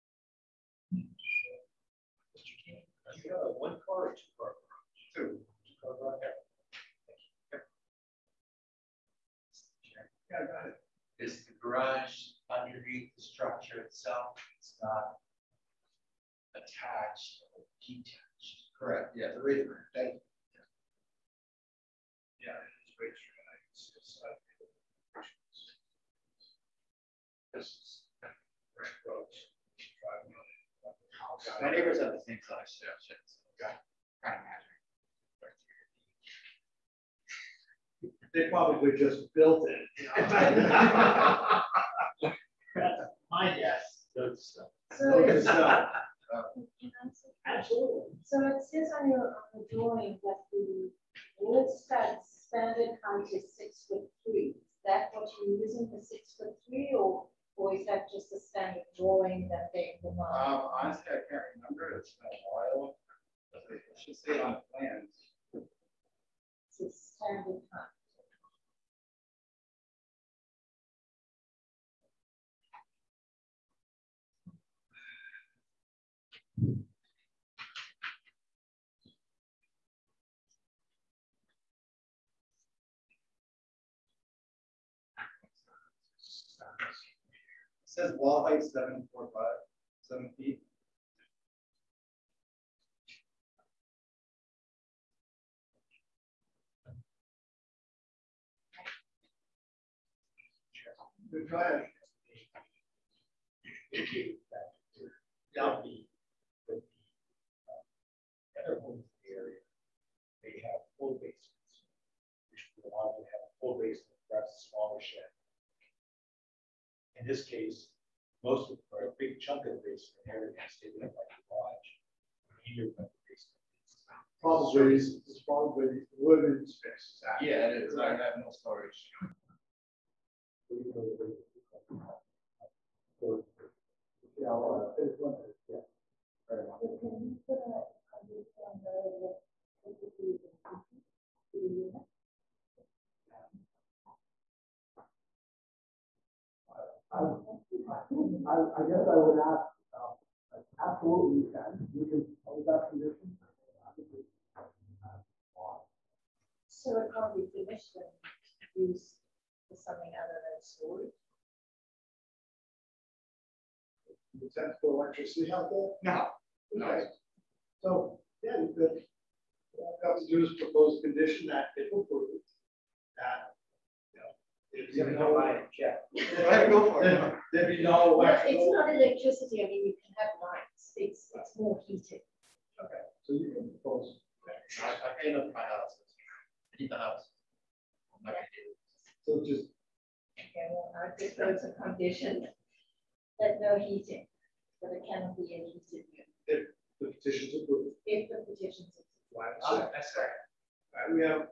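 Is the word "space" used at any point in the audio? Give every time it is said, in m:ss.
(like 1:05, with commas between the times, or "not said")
2:06, 2:14.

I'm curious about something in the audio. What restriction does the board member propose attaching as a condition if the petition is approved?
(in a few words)
No heating.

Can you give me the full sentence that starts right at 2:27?
I, I, I, guess I would ask, um, absolutely you can.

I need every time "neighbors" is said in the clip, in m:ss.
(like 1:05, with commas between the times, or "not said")
0:31.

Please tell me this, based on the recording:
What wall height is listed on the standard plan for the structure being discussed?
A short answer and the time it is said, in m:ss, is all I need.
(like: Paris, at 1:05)
7 feet, at 1:29.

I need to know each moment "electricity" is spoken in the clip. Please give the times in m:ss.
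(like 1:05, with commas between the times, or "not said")
2:19, 2:45, 2:58.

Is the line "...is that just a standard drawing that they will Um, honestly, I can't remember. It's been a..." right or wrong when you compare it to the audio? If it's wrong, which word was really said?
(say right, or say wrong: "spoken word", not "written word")
right.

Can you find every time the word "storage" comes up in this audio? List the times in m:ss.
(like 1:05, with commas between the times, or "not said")
2:08, 2:13, 2:40.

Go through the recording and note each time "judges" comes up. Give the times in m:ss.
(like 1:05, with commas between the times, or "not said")
not said.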